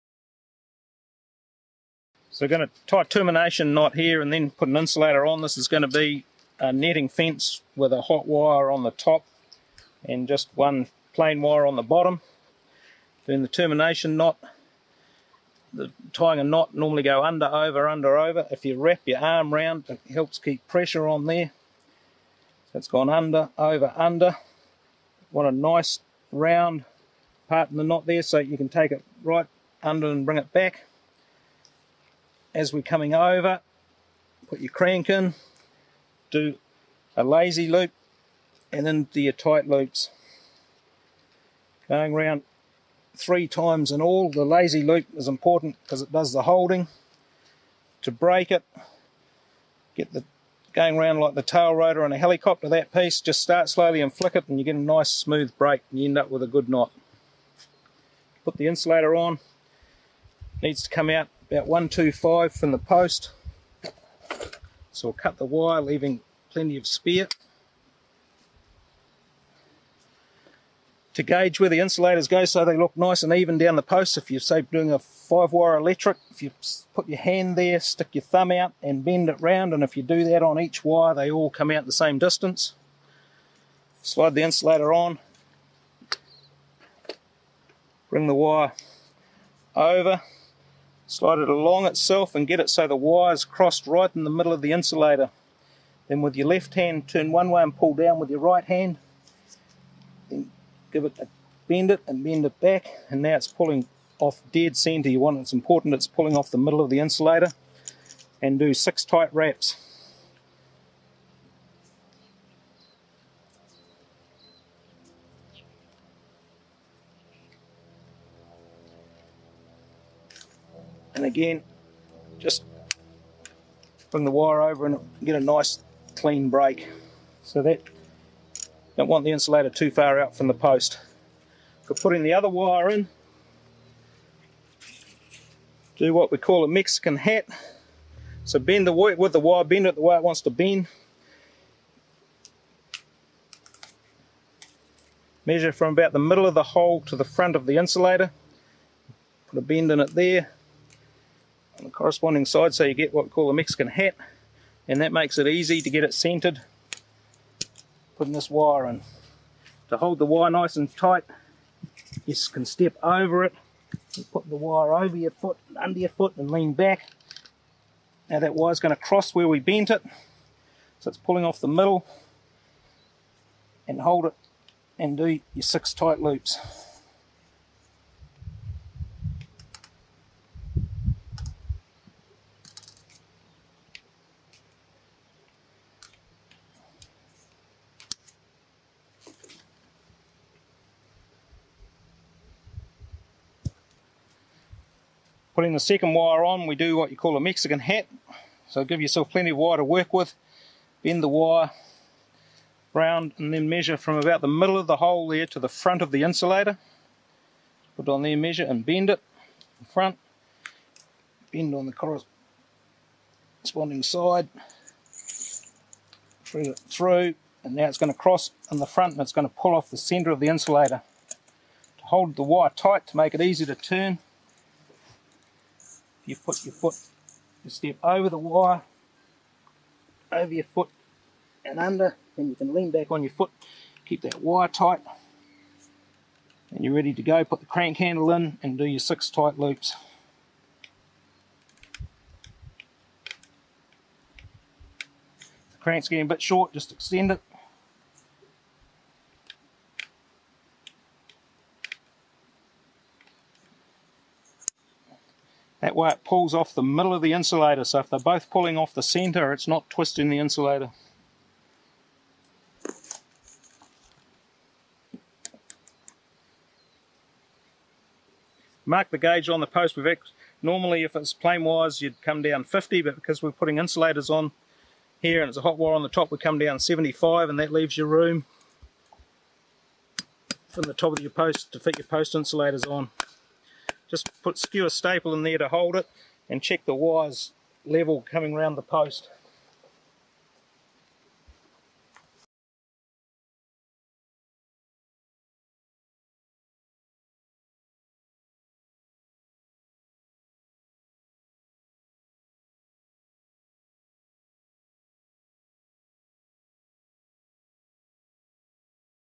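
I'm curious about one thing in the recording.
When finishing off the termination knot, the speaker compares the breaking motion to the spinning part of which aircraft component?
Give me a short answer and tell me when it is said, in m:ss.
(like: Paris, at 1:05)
tail rotor on a helicopter, at 0:51.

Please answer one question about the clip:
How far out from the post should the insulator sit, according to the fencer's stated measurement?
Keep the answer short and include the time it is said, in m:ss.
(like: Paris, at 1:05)
125, at 1:01.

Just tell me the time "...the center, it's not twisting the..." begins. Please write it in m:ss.
4:18.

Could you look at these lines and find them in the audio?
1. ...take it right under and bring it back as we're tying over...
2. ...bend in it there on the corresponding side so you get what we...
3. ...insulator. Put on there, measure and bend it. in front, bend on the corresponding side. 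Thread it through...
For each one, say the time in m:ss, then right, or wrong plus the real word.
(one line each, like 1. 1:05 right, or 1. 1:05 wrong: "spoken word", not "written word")
1. 0:28 wrong: "coming", not "tying"
2. 2:29 right
3. 3:26 right.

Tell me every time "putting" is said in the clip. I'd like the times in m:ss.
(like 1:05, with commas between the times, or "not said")
2:11, 2:38, 3:15, 4:33.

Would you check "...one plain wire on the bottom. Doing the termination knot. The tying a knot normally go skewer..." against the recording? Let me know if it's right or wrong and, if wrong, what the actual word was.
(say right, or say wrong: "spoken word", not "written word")
wrong: "under", not "skewer".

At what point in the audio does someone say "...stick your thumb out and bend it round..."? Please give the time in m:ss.
1:17.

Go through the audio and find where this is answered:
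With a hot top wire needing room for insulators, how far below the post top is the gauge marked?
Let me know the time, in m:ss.
4:36.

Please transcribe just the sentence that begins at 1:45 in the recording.
You want it's important it's pulling off the middle of the insulator.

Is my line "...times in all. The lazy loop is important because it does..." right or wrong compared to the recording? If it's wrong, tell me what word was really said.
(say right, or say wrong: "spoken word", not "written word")
right.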